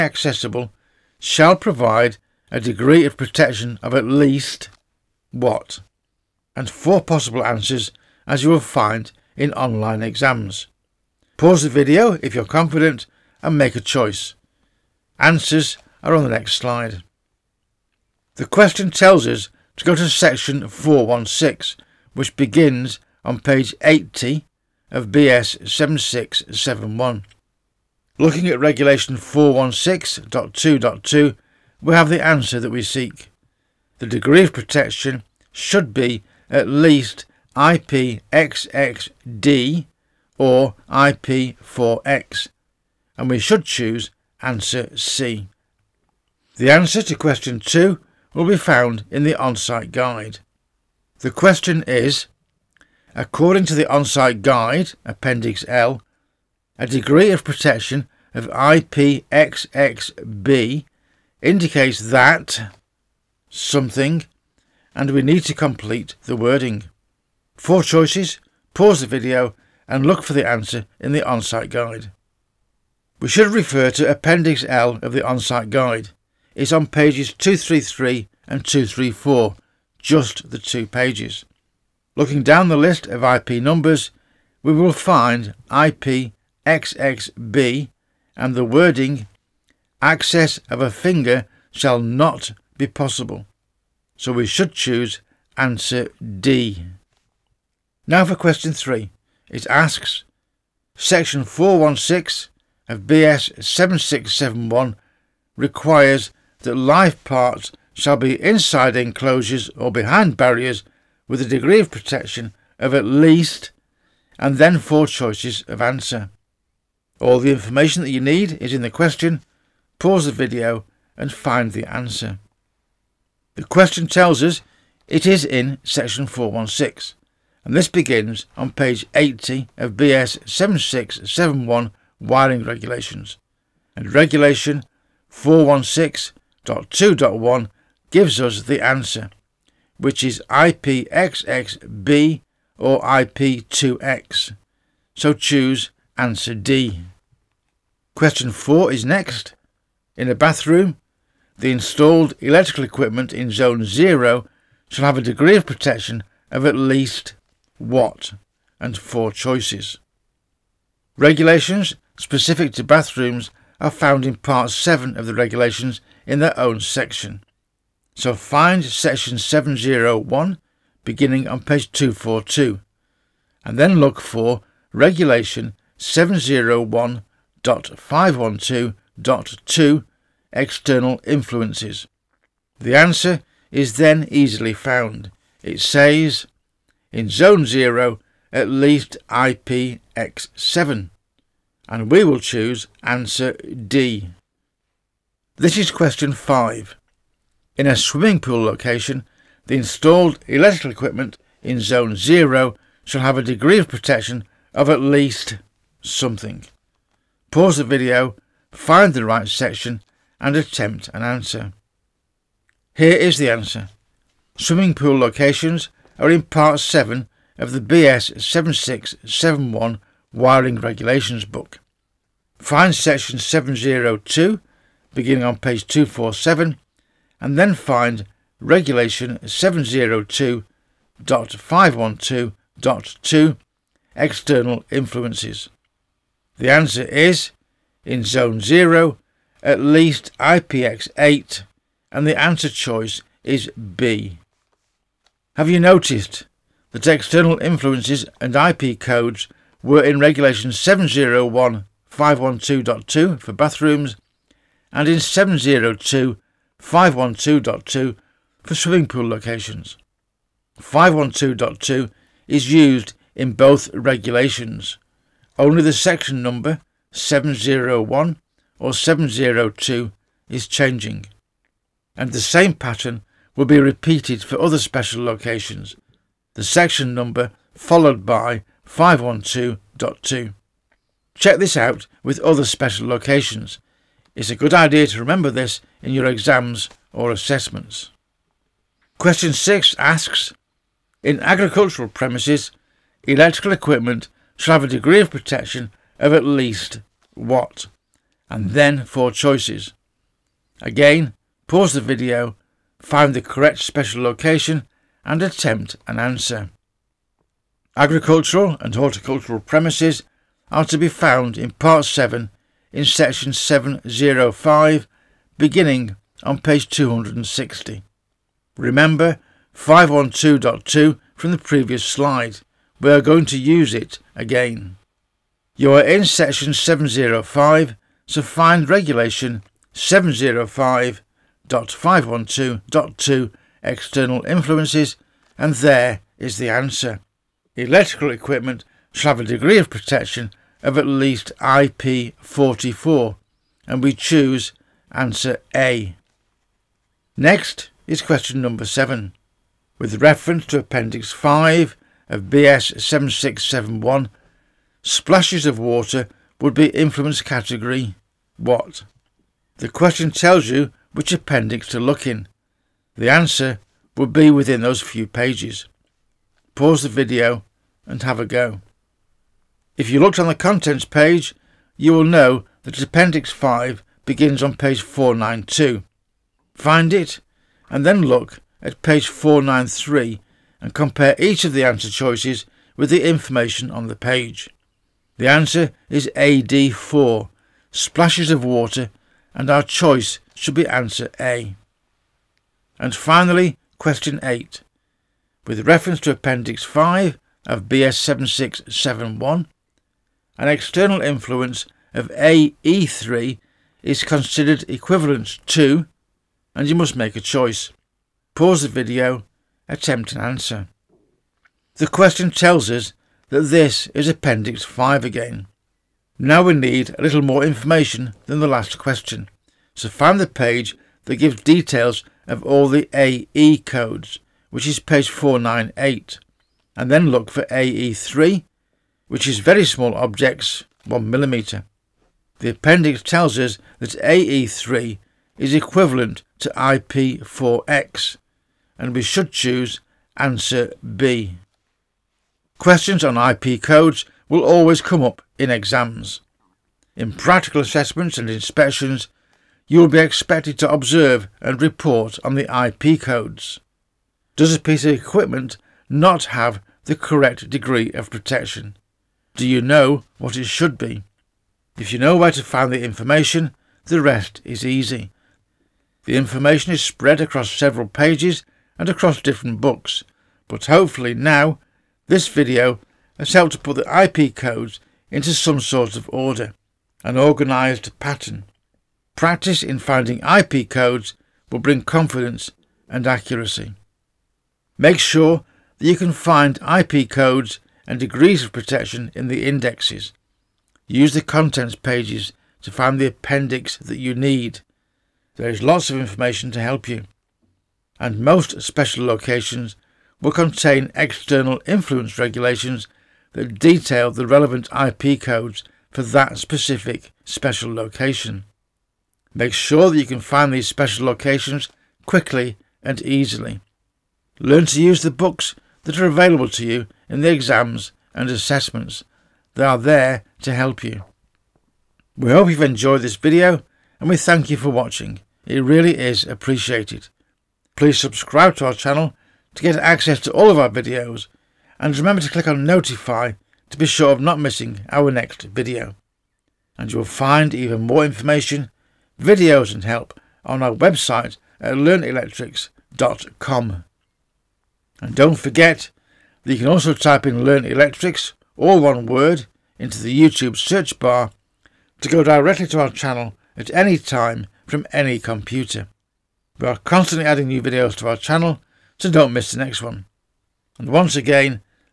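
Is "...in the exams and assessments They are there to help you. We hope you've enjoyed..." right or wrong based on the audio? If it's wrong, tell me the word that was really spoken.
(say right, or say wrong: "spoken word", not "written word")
right.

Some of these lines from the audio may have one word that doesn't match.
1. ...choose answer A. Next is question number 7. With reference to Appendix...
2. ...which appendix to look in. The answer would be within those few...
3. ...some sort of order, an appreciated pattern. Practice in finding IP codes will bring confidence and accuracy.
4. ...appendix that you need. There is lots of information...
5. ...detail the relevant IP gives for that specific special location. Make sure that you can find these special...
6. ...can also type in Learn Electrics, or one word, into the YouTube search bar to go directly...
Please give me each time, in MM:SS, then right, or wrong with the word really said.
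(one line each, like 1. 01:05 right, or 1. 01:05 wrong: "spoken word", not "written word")
1. 05:44 right
2. 06:01 right
3. 07:55 wrong: "organised", not "appreciated"
4. 08:13 right
5. 08:23 wrong: "codes", not "gives"
6. 09:06 right.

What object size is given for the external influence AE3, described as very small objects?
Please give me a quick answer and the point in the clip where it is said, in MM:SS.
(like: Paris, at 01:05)
1 millimeter, at 07:11.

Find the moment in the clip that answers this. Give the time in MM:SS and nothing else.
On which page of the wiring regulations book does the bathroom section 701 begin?
02:51.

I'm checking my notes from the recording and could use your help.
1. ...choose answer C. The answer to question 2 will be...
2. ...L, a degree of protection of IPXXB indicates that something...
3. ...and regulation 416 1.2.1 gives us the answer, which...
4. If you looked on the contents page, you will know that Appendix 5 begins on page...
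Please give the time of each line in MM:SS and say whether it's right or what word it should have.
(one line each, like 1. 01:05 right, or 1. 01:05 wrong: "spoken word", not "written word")
1. 00:43 right
2. 00:55 right
3. 02:13 right
4. 06:09 right.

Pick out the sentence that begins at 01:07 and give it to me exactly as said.
Four choices, pause the video and look for the answer in the on-site guide.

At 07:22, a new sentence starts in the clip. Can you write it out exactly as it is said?
Questions on IP codes will always come up in exams.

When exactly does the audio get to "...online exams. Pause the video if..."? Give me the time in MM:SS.
00:09.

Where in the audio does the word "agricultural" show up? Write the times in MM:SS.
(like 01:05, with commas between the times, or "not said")
04:51, 05:07.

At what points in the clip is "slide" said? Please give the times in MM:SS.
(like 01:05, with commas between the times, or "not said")
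00:16, 05:22.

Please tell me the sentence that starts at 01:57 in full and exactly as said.
All the information that you need is in the question, pause the video and find the answer.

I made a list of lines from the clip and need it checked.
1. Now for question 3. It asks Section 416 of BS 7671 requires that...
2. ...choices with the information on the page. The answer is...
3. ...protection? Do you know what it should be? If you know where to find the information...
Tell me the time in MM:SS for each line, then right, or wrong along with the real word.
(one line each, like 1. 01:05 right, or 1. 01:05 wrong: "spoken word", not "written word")
1. 01:38 right
2. 06:22 right
3. 07:38 right.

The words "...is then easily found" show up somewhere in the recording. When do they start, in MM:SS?
03:03.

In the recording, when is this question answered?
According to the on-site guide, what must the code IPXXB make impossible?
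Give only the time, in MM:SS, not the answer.
01:30.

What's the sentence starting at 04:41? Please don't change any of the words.
Check this out with other special locations it's a good idea to remember this in your exams or assessments.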